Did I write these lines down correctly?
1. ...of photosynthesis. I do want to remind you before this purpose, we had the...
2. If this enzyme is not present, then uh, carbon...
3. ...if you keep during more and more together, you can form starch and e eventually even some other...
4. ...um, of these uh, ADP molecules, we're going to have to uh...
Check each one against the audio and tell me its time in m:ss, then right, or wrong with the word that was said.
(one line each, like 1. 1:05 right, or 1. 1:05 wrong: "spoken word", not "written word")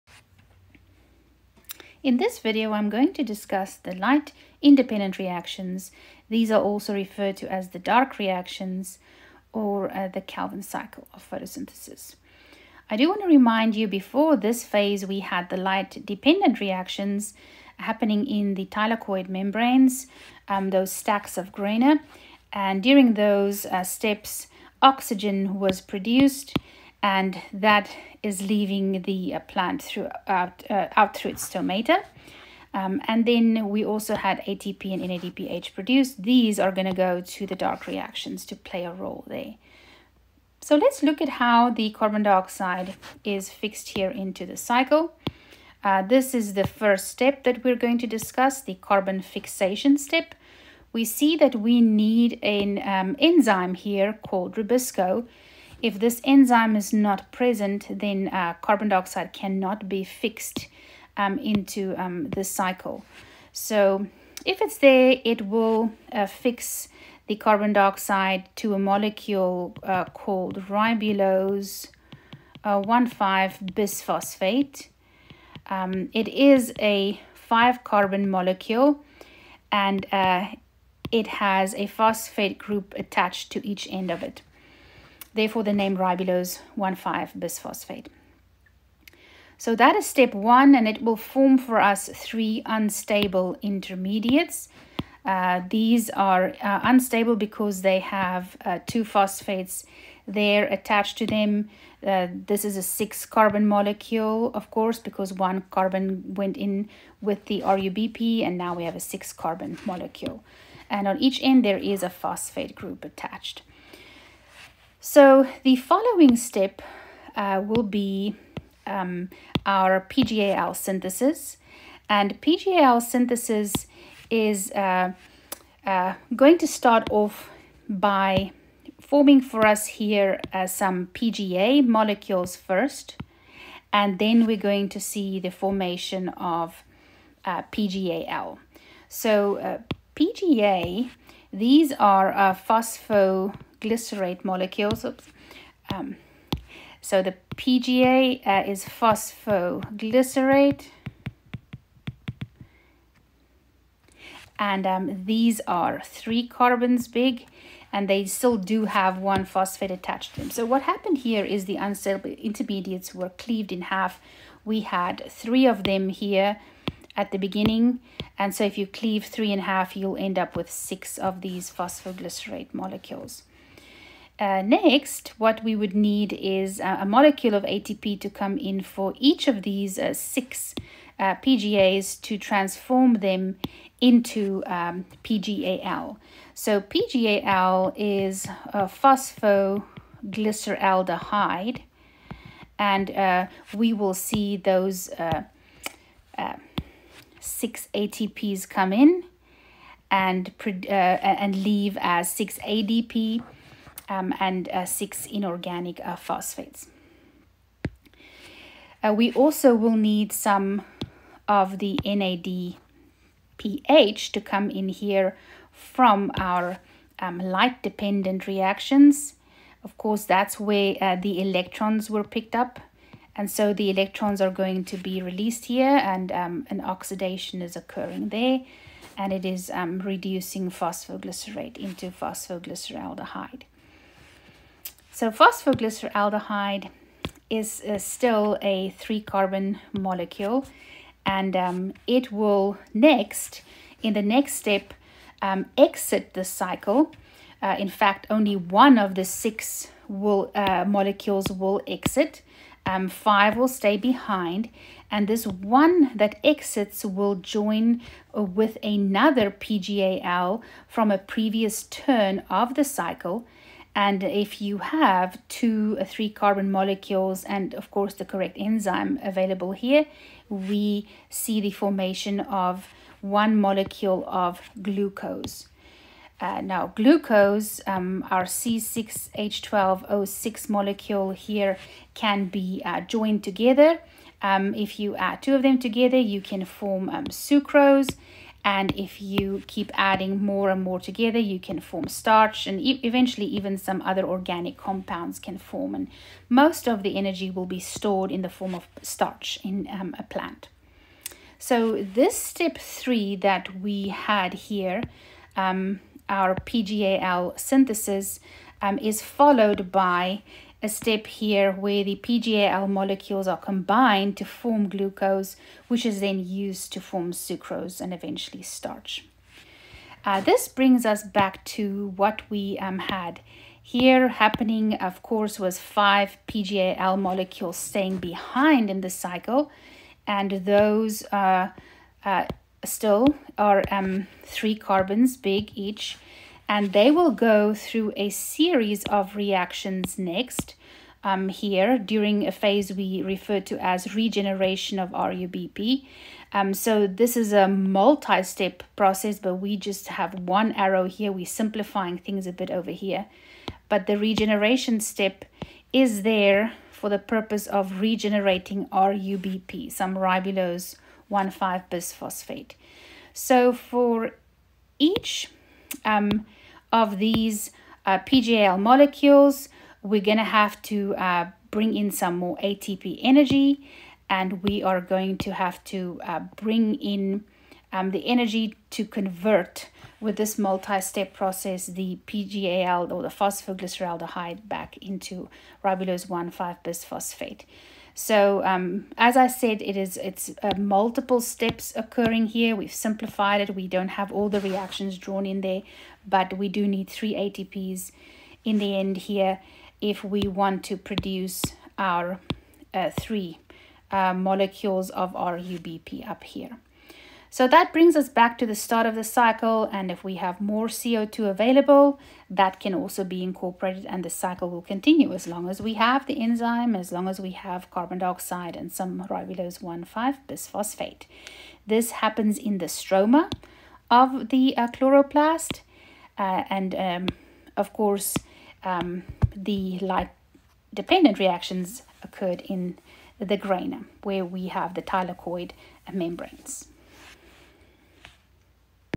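1. 0:11 wrong: "phase", not "purpose"
2. 0:55 right
3. 4:48 wrong: "adding", not "during"
4. 6:06 wrong: "PGL", not "ADP".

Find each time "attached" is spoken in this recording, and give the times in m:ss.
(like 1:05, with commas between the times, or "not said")
1:22, 1:40, 1:53, 2:39.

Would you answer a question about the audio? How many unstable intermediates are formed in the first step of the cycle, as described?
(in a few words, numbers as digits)
3.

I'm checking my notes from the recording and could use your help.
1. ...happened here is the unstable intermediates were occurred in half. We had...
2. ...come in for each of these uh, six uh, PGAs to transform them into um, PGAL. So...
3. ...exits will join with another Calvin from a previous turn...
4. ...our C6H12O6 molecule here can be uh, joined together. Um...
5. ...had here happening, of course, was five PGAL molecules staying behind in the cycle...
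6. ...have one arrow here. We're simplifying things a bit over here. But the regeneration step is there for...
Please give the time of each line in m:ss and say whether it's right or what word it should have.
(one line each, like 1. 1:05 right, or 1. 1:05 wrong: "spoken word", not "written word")
1. 2:40 wrong: "cleaved", not "occurred"
2. 2:58 right
3. 4:16 wrong: "PGAL", not "Calvin"
4. 4:38 right
5. 5:22 right
6. 5:50 right.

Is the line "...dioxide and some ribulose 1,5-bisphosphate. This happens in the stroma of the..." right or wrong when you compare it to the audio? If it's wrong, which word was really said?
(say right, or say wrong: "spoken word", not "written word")
right.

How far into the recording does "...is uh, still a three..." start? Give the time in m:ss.
3:57.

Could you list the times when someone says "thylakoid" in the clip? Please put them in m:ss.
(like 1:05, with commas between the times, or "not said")
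0:18, 7:15.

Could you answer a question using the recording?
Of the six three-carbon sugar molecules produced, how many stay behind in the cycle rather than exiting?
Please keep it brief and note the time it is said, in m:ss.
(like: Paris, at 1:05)
5, at 4:13.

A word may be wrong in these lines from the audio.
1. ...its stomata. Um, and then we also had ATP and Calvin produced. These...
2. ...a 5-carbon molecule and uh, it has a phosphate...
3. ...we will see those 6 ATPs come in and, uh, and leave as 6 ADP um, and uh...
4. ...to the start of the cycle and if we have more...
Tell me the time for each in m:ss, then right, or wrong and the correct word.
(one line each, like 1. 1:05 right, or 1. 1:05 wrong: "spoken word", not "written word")
1. 0:31 wrong: "NADPH", not "Calvin"
2. 1:16 right
3. 3:13 right
4. 6:48 right.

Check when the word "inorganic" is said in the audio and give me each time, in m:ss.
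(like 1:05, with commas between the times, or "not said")
3:25.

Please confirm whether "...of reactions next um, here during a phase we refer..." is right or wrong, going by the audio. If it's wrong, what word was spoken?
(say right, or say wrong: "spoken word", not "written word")
right.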